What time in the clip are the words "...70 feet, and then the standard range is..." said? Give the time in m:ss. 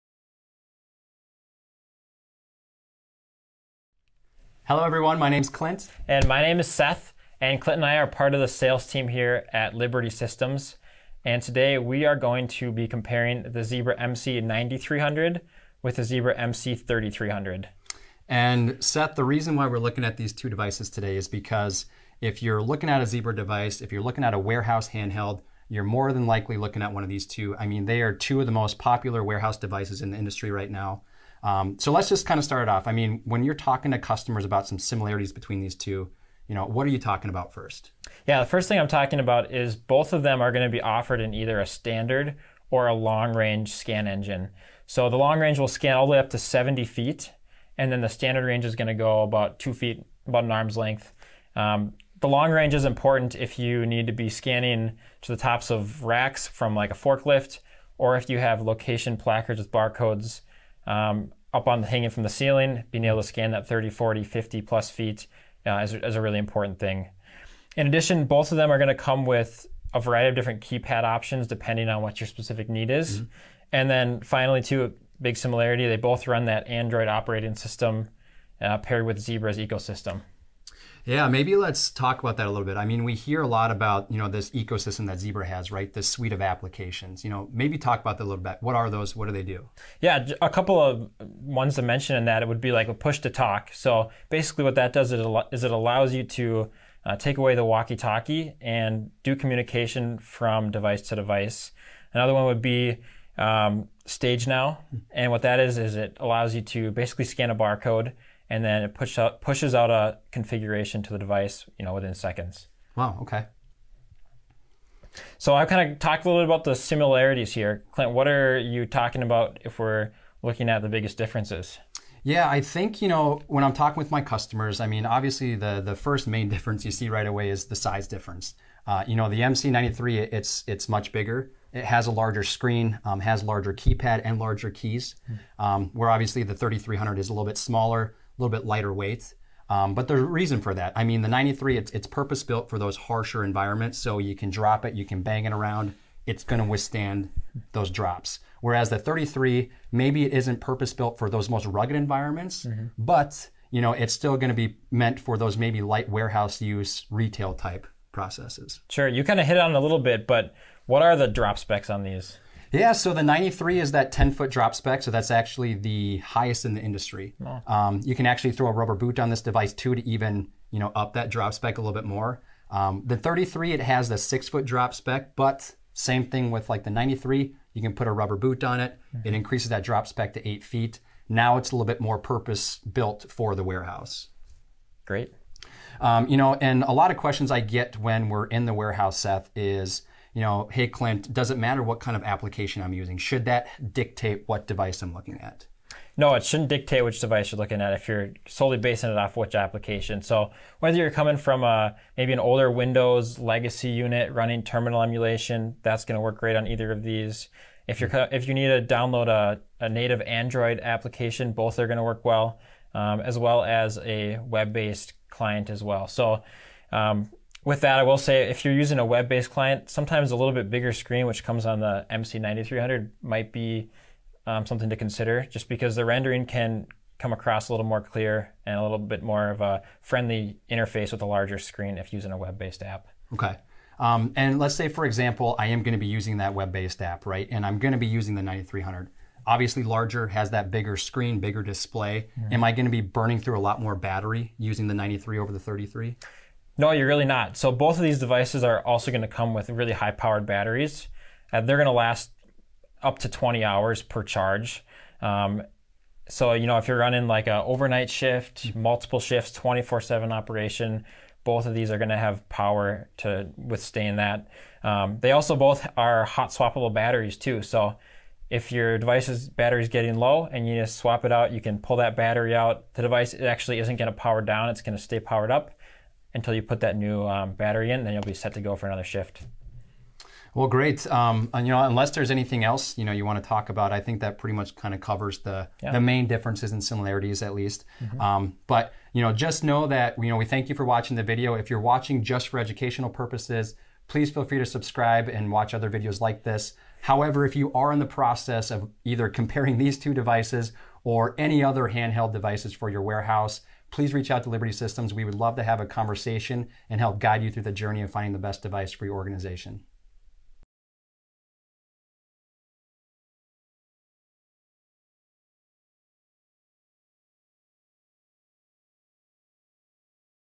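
0:46.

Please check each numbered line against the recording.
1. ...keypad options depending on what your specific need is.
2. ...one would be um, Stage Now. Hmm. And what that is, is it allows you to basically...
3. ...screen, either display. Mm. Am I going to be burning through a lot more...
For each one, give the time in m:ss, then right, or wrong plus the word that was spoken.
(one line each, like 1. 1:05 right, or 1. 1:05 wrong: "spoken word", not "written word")
1. 1:10 right
2. 1:42 right
3. 4:00 wrong: "bigger", not "either".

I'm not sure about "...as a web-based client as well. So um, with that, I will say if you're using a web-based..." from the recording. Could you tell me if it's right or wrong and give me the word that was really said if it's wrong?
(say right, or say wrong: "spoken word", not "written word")
right.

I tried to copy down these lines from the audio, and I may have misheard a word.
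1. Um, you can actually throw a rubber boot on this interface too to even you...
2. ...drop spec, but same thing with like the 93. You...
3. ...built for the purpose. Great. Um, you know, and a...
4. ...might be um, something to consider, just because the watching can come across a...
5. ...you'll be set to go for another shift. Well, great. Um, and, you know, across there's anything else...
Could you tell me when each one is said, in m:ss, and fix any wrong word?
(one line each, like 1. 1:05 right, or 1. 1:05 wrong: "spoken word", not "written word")
1. 2:47 wrong: "device", not "interface"
2. 2:54 right
3. 3:02 wrong: "warehouse", not "purpose"
4. 3:43 wrong: "rendering", not "watching"
5. 4:38 wrong: "unless", not "across".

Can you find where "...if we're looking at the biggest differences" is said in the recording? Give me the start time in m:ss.
1:59.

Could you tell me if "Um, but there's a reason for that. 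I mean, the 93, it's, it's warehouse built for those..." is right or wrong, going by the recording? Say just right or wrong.
wrong.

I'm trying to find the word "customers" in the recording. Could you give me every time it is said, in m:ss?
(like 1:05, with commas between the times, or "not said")
0:33, 2:04.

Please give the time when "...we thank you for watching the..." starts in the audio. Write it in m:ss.
4:50.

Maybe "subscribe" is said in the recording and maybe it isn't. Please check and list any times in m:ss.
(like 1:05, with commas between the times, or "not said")
4:54.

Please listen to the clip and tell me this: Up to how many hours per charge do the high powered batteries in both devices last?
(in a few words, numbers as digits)
20 hours.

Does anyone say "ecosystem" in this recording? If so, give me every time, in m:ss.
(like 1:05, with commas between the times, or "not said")
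1:19, 1:24.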